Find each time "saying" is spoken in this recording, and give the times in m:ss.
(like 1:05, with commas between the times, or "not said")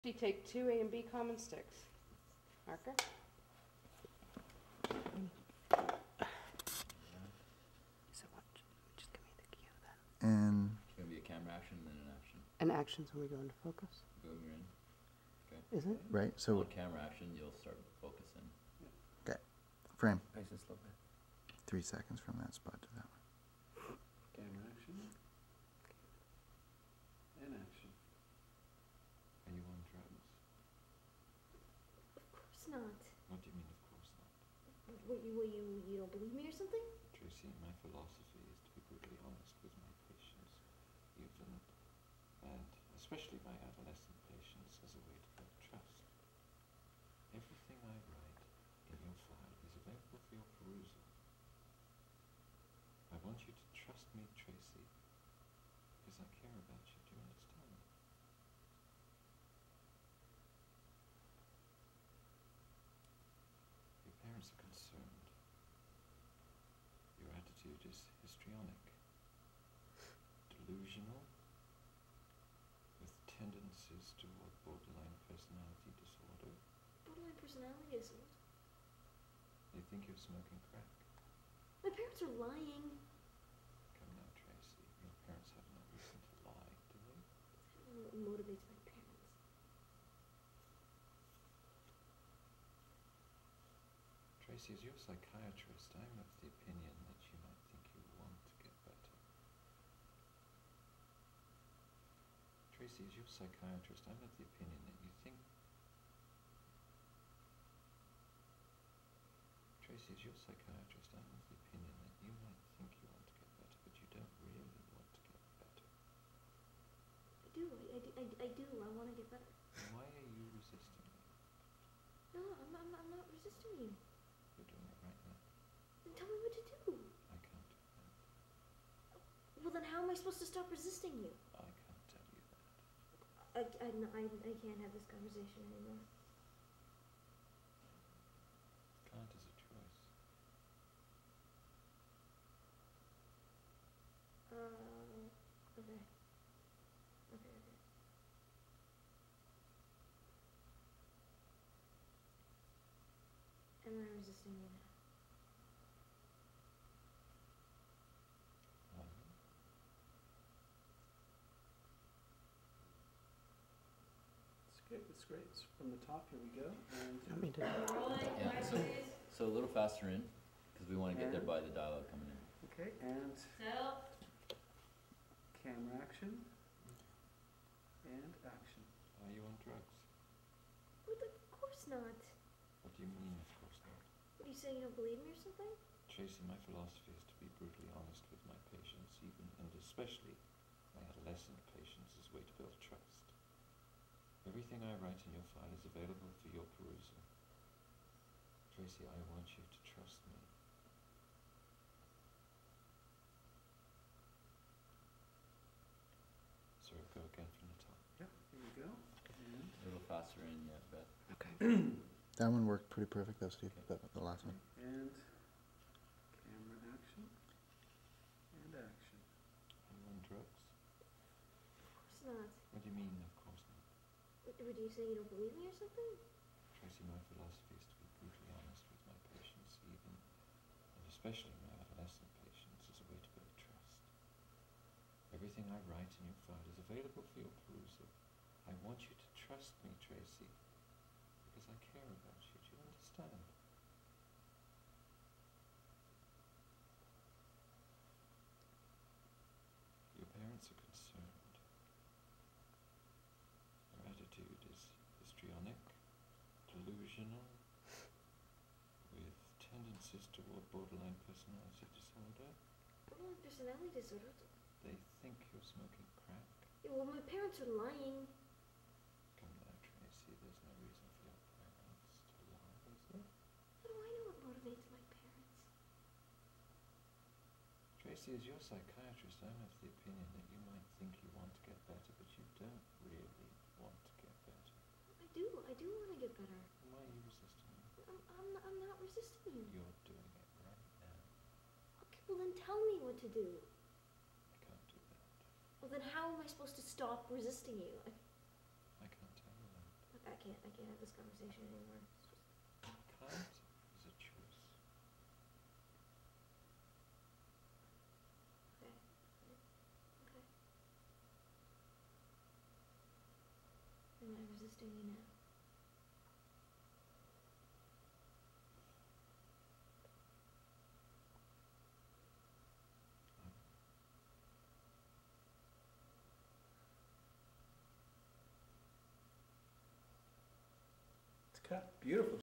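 3:04, 3:44.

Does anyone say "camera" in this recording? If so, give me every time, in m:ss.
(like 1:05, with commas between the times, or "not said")
0:11, 0:16, 0:24, 2:55, 3:36.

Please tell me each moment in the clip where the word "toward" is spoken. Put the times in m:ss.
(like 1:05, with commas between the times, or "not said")
1:14, 4:20.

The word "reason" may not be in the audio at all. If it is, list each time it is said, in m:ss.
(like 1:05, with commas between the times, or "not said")
1:25, 4:30.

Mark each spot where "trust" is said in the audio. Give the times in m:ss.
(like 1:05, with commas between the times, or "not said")
0:45, 0:53, 3:12, 3:19, 3:53, 3:59.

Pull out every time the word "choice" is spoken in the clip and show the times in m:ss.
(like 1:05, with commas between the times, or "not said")
2:19, 5:04.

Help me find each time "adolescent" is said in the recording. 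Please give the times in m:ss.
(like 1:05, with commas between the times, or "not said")
0:43, 3:11, 3:51.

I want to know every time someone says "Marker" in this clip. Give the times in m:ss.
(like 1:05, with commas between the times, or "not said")
0:02.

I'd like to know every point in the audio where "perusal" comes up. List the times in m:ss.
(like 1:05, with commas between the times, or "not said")
0:50, 3:16, 3:57.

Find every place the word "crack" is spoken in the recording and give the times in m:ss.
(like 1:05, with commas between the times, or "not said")
1:20, 4:26.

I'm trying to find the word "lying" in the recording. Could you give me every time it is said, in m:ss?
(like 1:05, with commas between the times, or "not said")
1:22, 4:27.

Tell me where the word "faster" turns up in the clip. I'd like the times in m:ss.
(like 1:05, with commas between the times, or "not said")
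2:49, 3:30.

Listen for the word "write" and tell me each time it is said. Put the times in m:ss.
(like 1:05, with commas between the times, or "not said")
0:48, 3:14, 3:55.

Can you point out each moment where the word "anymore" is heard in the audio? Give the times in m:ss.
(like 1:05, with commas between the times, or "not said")
2:15, 5:01.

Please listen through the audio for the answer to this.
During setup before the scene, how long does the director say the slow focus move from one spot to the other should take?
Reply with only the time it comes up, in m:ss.
0:21.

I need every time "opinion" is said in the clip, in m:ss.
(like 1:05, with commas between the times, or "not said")
1:36, 1:44, 1:51, 4:39.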